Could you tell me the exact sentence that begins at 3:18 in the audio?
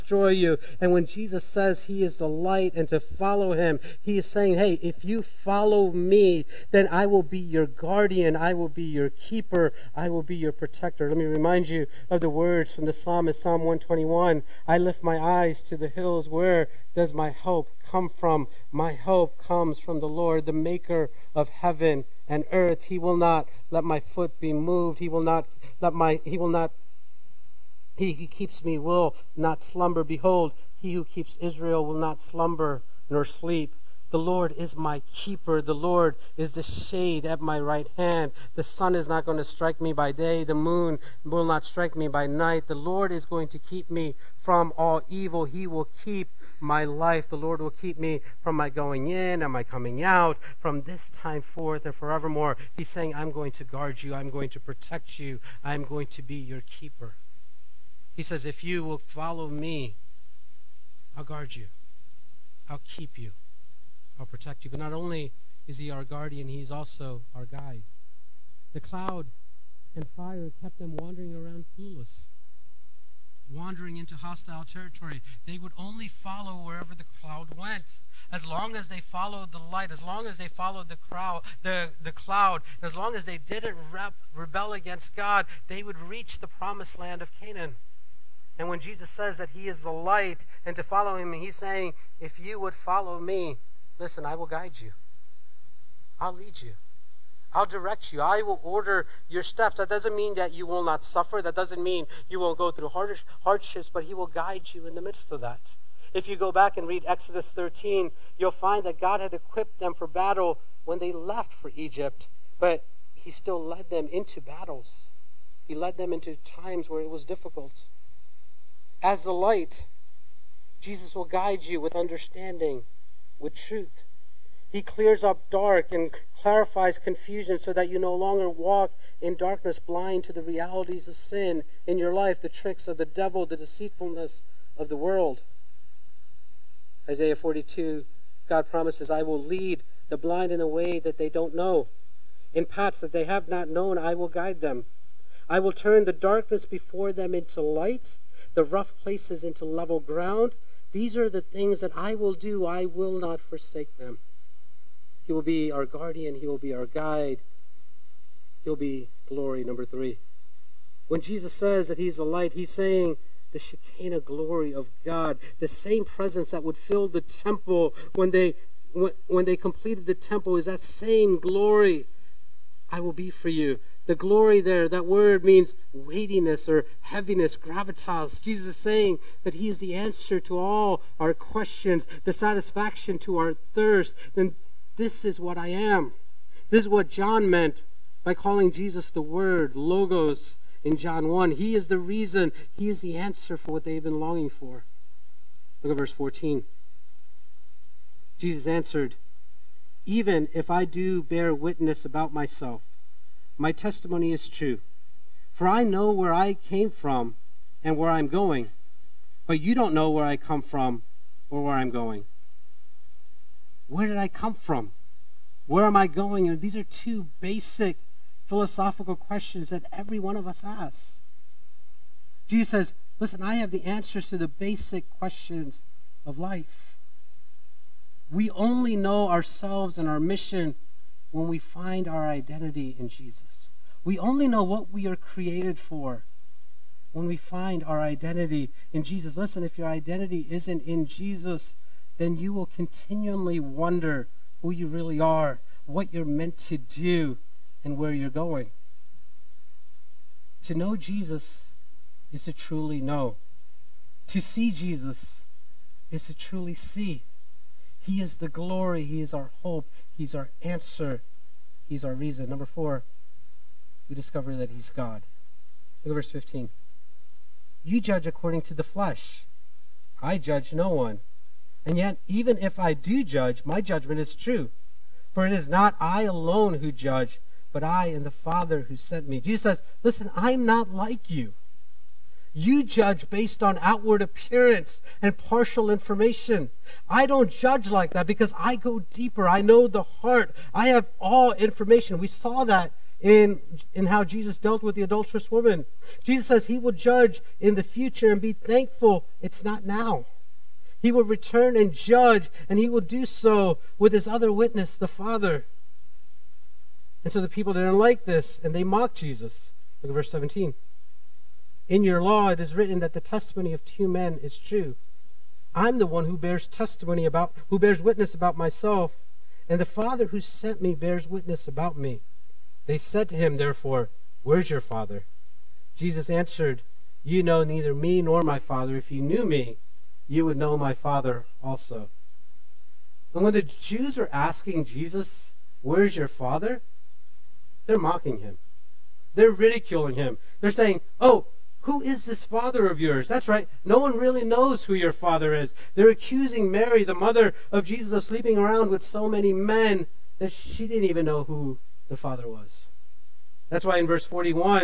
Jesus answered, Even if I do bear witness about myself, my testimony is true.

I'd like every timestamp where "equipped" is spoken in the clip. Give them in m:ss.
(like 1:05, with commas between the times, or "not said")
1:49.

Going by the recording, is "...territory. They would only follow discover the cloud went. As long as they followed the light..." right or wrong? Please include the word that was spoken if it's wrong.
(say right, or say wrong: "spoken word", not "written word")
wrong: "wherever", not "discover".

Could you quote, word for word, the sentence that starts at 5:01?
He will return and judge, and he will do so with his other witness, the Father.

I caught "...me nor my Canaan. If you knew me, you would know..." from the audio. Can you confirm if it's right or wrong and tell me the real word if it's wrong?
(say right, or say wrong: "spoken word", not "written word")
wrong: "Father", not "Canaan".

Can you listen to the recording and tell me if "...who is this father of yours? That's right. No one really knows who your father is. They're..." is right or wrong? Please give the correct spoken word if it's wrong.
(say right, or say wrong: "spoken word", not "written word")
right.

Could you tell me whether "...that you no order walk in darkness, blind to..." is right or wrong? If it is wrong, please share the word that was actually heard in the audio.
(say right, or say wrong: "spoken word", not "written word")
wrong: "longer", not "order".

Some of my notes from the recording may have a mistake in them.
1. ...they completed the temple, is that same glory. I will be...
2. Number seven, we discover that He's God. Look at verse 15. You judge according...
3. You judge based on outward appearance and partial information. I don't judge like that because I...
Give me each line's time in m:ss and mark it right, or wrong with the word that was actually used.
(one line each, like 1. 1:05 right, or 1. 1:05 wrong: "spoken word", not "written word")
1. 2:49 right
2. 4:22 wrong: "four", not "seven"
3. 4:42 right.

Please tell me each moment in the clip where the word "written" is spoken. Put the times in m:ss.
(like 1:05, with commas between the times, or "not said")
5:12.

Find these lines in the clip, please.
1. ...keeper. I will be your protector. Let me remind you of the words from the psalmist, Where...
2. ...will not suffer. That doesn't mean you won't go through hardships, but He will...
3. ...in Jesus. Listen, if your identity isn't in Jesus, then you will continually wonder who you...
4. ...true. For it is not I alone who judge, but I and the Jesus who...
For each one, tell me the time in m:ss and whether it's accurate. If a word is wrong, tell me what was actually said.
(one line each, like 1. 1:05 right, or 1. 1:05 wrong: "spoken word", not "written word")
1. 0:09 wrong: "Psalm", not "Where"
2. 1:40 right
3. 3:58 right
4. 4:34 wrong: "Father", not "Jesus".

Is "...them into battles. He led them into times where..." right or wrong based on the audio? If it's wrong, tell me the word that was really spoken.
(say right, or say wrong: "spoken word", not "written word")
right.